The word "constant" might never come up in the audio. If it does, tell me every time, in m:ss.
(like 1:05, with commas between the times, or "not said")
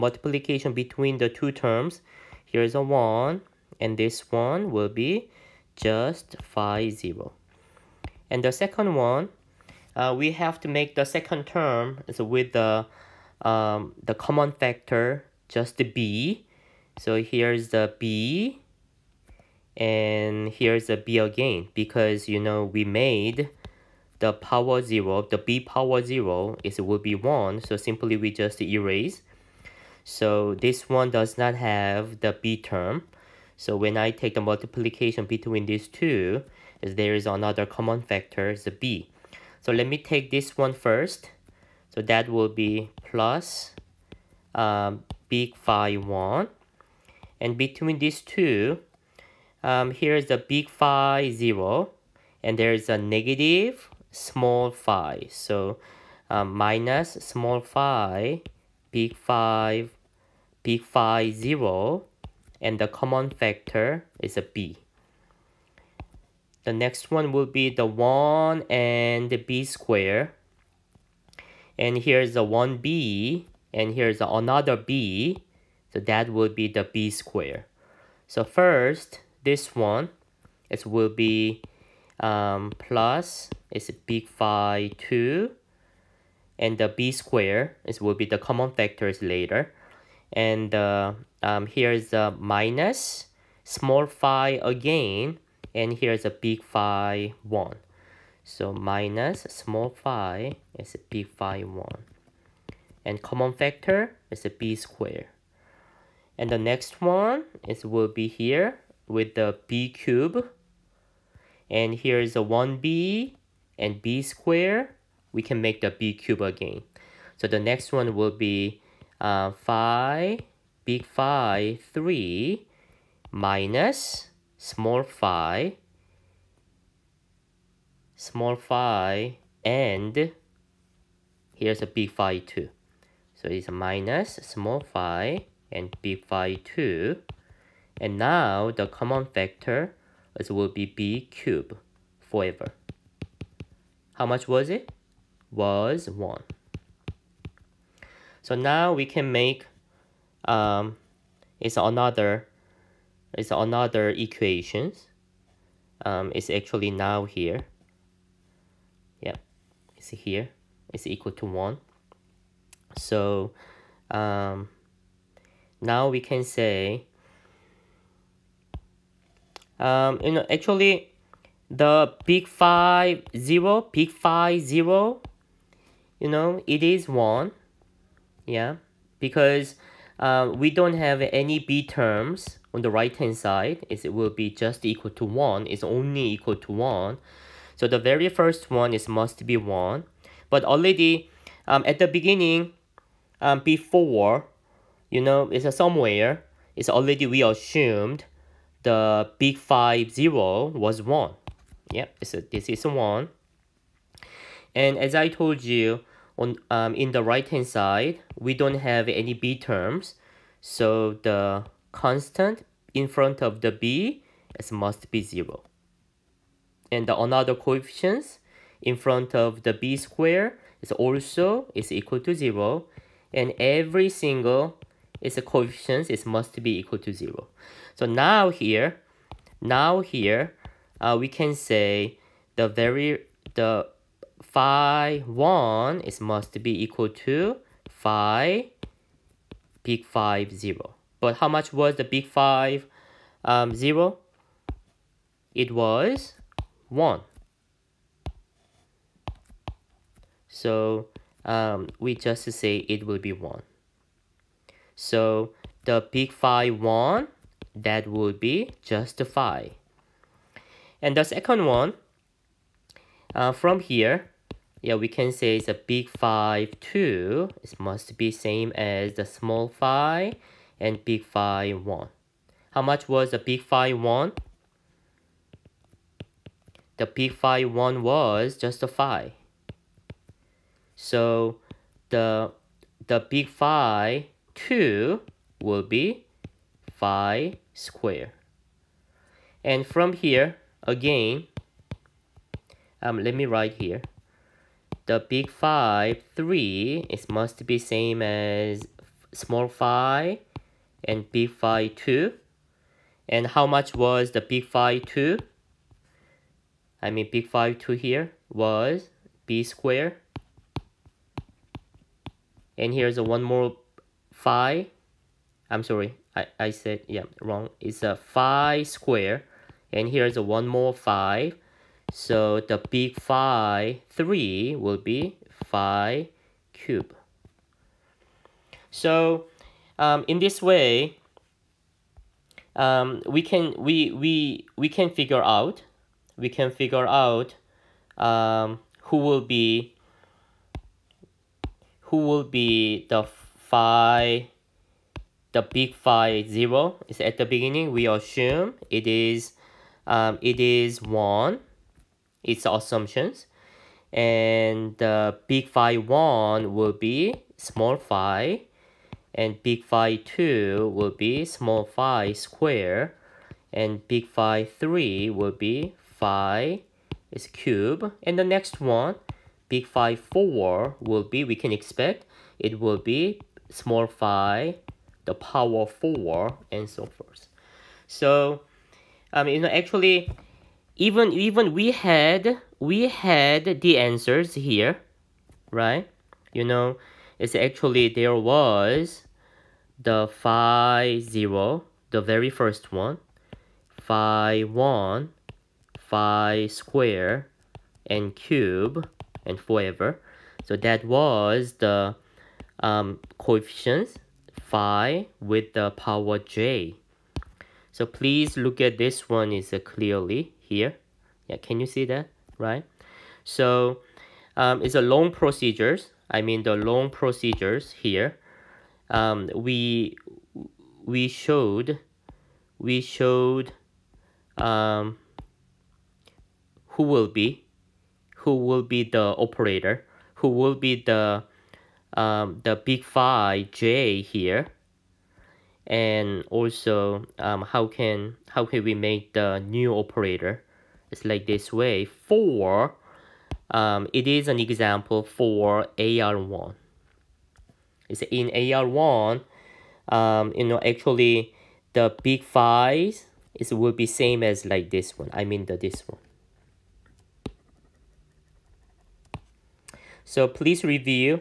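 3:31.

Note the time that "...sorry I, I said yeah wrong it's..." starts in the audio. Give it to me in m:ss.
5:15.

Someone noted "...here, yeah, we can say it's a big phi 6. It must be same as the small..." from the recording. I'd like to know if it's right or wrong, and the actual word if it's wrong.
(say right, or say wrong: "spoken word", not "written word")
wrong: "2", not "6".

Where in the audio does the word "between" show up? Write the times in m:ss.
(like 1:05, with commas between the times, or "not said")
0:00, 0:35, 0:47.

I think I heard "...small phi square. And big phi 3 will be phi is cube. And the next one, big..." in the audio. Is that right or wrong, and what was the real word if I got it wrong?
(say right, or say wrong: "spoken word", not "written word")
right.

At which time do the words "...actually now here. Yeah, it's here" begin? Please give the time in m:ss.
2:36.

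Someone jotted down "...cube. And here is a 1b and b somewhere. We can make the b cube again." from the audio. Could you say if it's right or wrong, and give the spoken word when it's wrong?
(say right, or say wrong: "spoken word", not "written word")
wrong: "square", not "somewhere".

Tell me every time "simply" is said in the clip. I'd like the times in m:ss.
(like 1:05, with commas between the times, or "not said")
0:27.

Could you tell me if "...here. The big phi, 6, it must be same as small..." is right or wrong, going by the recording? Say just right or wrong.
wrong.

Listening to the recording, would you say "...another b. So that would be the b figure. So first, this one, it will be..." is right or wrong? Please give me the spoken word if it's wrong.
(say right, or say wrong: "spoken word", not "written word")
wrong: "square", not "figure".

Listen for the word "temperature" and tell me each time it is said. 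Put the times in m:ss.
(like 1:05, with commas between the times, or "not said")
not said.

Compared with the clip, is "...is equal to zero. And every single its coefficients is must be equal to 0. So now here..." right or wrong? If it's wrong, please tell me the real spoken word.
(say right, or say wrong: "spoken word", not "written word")
right.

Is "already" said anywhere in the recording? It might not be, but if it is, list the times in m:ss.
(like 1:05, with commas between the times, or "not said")
3:10, 3:16.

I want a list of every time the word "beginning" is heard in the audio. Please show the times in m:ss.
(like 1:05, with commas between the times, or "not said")
3:12, 5:47.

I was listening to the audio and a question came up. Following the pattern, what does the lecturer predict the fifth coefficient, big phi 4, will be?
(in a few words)
phi to the power 4.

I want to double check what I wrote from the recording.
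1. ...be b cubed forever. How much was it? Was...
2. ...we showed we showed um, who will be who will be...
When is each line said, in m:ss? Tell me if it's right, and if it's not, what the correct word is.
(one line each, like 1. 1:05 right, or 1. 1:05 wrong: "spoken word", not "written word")
1. 2:20 right
2. 7:01 right.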